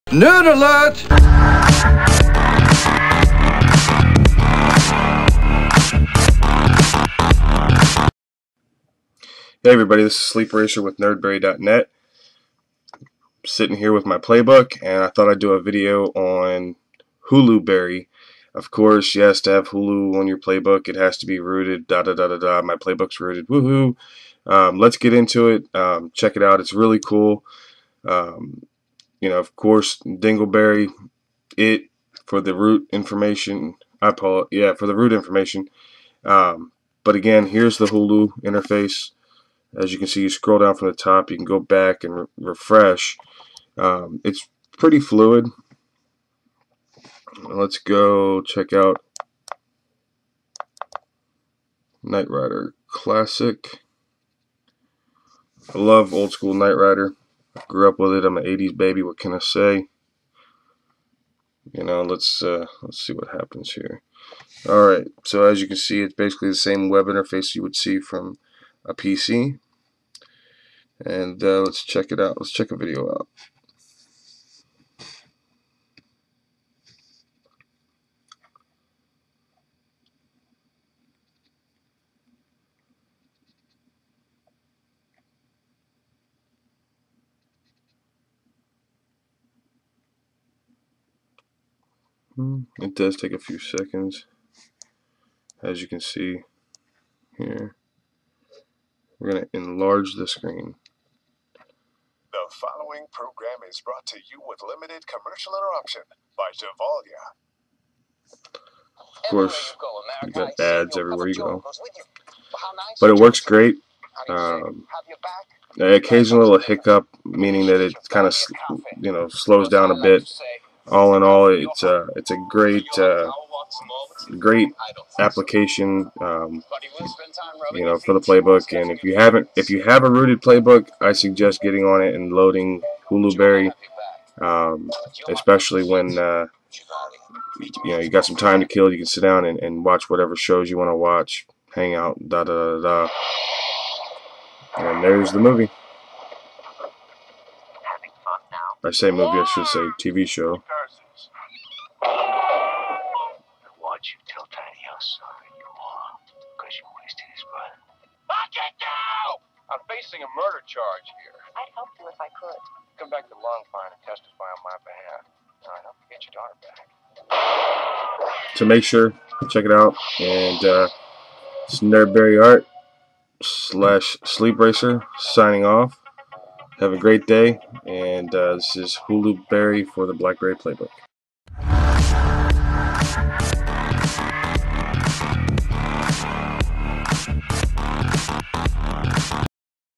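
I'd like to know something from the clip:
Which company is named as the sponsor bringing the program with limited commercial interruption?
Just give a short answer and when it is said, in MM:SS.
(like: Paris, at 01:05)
Gevalia, at 01:46.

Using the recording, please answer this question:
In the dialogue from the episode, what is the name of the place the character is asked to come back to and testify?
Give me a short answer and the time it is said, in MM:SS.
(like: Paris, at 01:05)
Longpine, at 02:43.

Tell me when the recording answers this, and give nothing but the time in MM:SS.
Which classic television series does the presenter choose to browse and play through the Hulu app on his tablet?
00:52.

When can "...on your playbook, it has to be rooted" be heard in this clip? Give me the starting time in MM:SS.
00:20.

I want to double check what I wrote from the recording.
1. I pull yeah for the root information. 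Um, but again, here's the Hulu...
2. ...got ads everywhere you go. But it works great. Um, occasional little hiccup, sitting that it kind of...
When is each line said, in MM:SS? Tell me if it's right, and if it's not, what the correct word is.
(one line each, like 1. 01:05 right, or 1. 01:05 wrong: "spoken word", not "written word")
1. 00:34 right
2. 01:50 wrong: "meaning", not "sitting".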